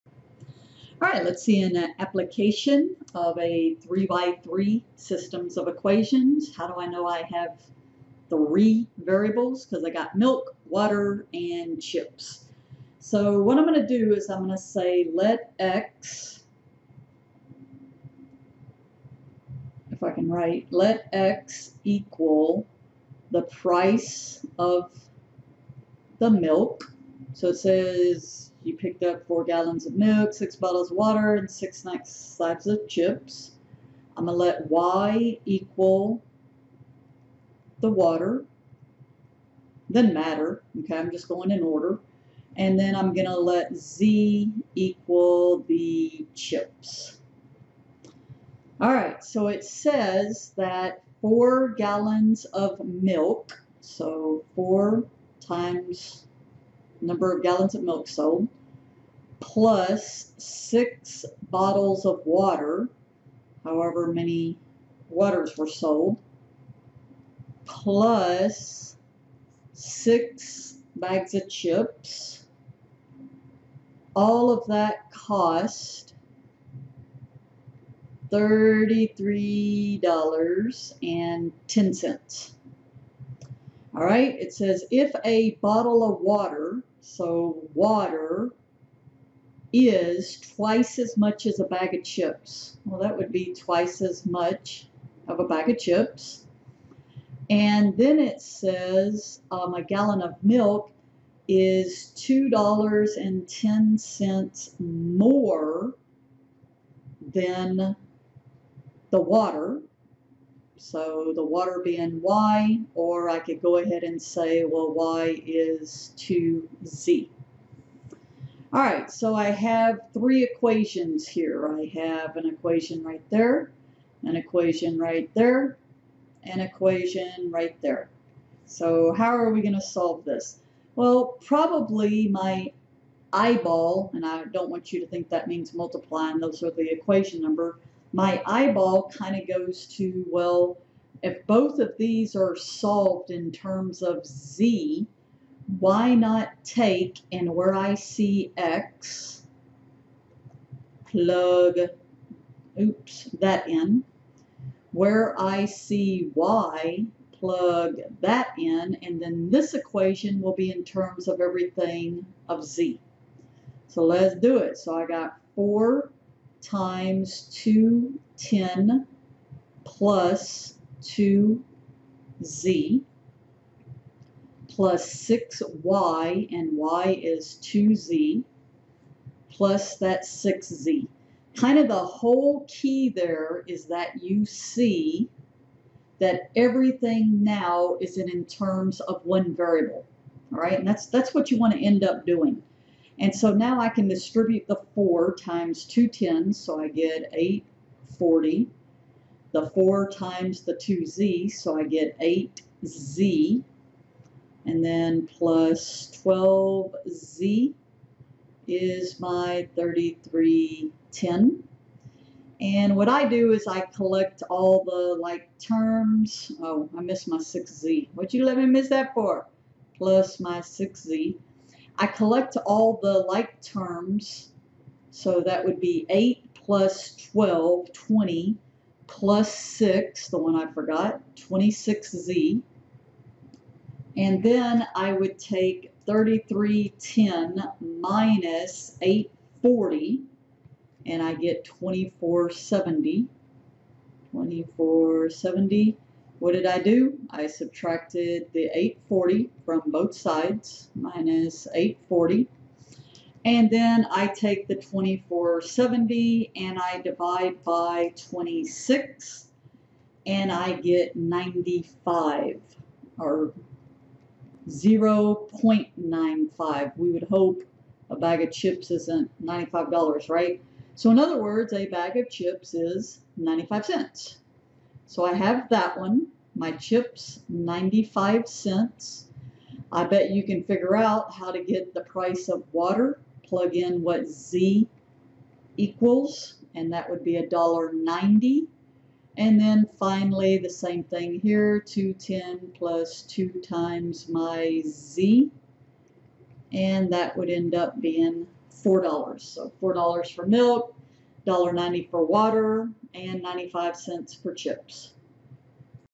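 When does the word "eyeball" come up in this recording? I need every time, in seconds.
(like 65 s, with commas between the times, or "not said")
133 s, 138 s.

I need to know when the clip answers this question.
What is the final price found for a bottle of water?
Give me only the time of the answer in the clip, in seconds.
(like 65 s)
287 s.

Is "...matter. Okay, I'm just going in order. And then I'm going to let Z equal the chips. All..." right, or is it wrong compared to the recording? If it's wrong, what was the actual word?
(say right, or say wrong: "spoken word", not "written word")
right.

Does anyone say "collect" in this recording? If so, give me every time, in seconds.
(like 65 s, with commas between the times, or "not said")
213 s, 222 s.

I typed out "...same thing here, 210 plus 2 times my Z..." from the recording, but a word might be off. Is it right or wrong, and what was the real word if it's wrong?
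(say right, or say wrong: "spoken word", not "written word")
right.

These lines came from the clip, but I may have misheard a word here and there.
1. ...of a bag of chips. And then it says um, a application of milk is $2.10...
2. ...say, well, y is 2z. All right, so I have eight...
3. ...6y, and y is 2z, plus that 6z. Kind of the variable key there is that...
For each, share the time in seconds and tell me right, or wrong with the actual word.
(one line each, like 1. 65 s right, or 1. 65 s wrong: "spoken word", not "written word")
1. 95 s wrong: "gallon", not "application"
2. 114 s wrong: "three", not "eight"
3. 175 s wrong: "whole", not "variable".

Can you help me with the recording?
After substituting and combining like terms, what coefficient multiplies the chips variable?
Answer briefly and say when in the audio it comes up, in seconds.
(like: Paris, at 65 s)
26, at 231 s.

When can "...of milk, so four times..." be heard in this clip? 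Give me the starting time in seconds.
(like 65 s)
52 s.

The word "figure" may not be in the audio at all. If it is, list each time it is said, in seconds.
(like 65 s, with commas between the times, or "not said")
280 s.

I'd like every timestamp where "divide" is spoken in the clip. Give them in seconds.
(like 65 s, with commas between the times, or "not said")
257 s.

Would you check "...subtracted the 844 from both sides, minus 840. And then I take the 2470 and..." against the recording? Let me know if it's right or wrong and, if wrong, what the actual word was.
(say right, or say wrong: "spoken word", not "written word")
wrong: "840", not "844".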